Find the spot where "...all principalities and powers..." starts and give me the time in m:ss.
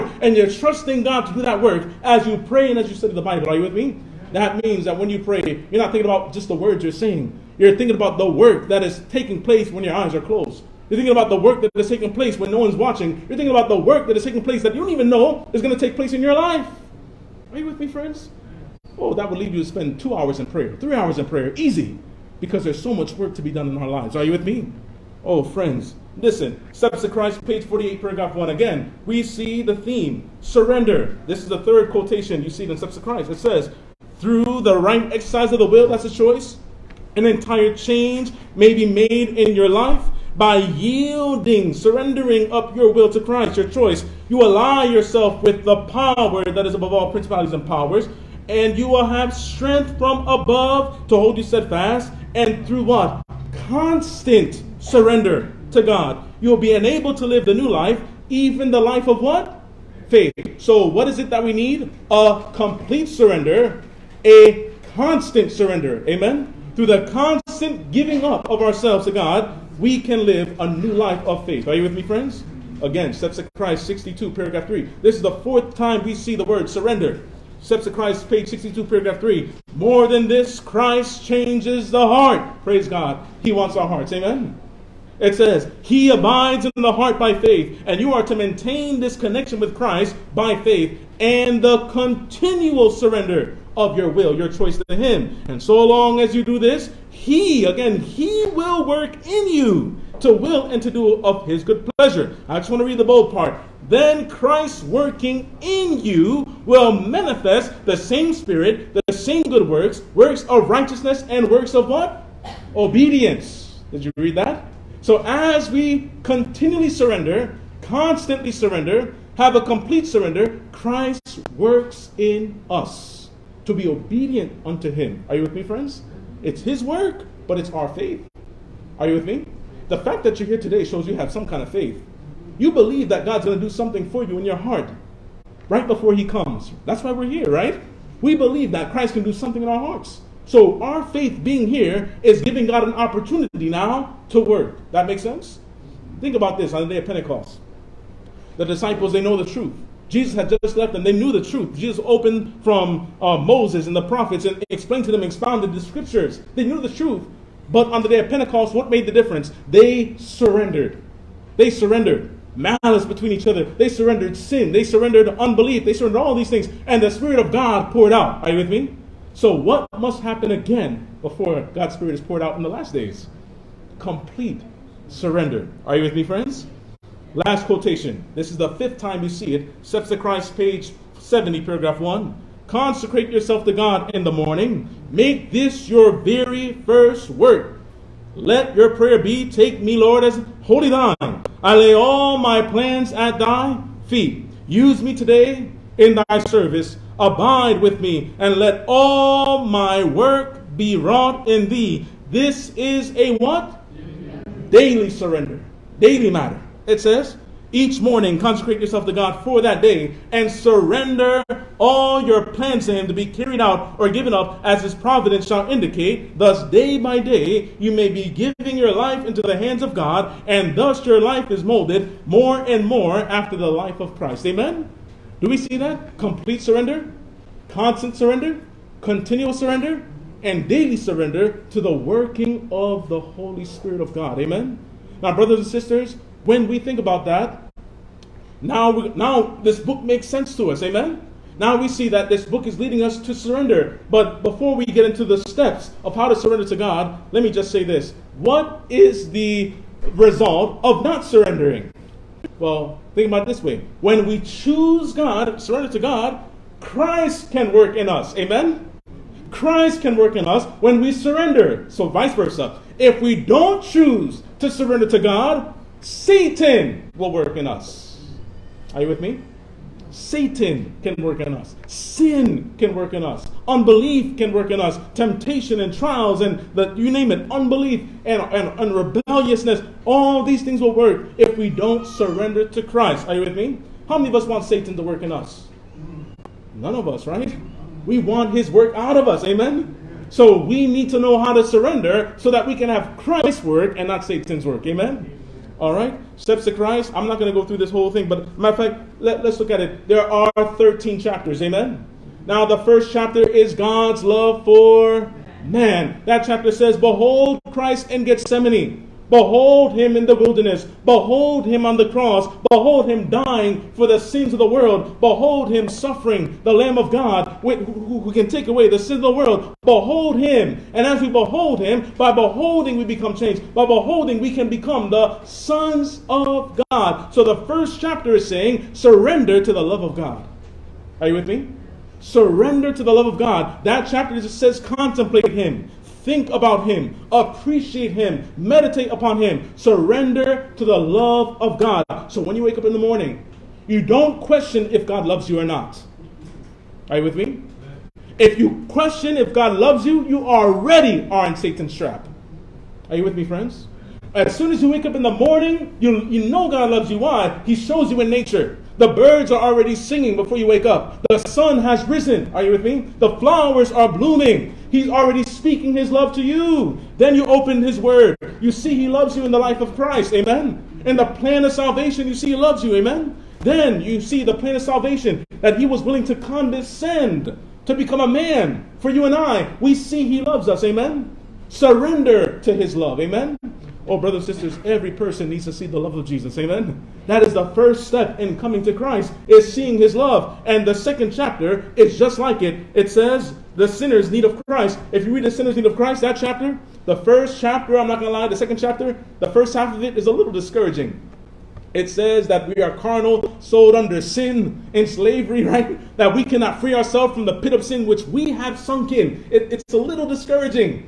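0:46.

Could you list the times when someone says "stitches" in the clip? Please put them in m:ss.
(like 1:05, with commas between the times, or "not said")
not said.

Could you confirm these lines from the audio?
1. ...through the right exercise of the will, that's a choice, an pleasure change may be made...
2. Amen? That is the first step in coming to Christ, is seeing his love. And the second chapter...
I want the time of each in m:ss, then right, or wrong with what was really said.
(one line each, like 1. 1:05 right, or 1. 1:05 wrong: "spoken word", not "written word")
1. 0:34 wrong: "entire", not "pleasure"
2. 6:26 right.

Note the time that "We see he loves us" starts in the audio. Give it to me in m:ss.
6:19.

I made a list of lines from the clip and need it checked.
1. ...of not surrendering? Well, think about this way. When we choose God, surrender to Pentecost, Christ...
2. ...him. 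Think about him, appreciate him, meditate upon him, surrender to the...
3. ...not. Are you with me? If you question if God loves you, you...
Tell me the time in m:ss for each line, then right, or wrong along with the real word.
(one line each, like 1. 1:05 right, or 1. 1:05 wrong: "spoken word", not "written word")
1. 4:10 wrong: "God", not "Pentecost"
2. 5:35 right
3. 5:45 right.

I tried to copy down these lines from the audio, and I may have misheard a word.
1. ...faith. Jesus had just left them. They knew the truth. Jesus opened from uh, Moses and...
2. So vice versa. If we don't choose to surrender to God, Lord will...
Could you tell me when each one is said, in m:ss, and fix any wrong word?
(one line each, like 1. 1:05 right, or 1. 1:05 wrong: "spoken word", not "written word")
1. 2:29 wrong: "truth", not "faith"
2. 4:21 wrong: "Satan", not "Lord".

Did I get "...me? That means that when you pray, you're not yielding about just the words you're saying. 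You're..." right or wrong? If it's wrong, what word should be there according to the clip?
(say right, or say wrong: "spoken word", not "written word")
wrong: "thinking", not "yielding".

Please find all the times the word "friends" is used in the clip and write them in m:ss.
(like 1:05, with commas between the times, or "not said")
0:17, 0:25, 1:12, 2:05, 2:56, 5:53.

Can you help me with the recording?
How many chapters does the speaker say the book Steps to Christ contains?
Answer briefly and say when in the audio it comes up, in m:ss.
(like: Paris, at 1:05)
13, at 5:00.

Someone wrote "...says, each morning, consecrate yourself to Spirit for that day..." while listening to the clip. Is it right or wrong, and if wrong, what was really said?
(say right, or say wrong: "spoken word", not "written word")
wrong: "God", not "Spirit".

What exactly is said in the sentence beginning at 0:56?
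You'll be enabled to live the new life, even the life of what?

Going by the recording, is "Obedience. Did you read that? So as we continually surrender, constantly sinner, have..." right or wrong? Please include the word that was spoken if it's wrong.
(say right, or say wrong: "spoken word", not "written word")
wrong: "surrender", not "sinner".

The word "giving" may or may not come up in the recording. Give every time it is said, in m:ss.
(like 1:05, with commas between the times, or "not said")
1:07, 2:22, 3:38.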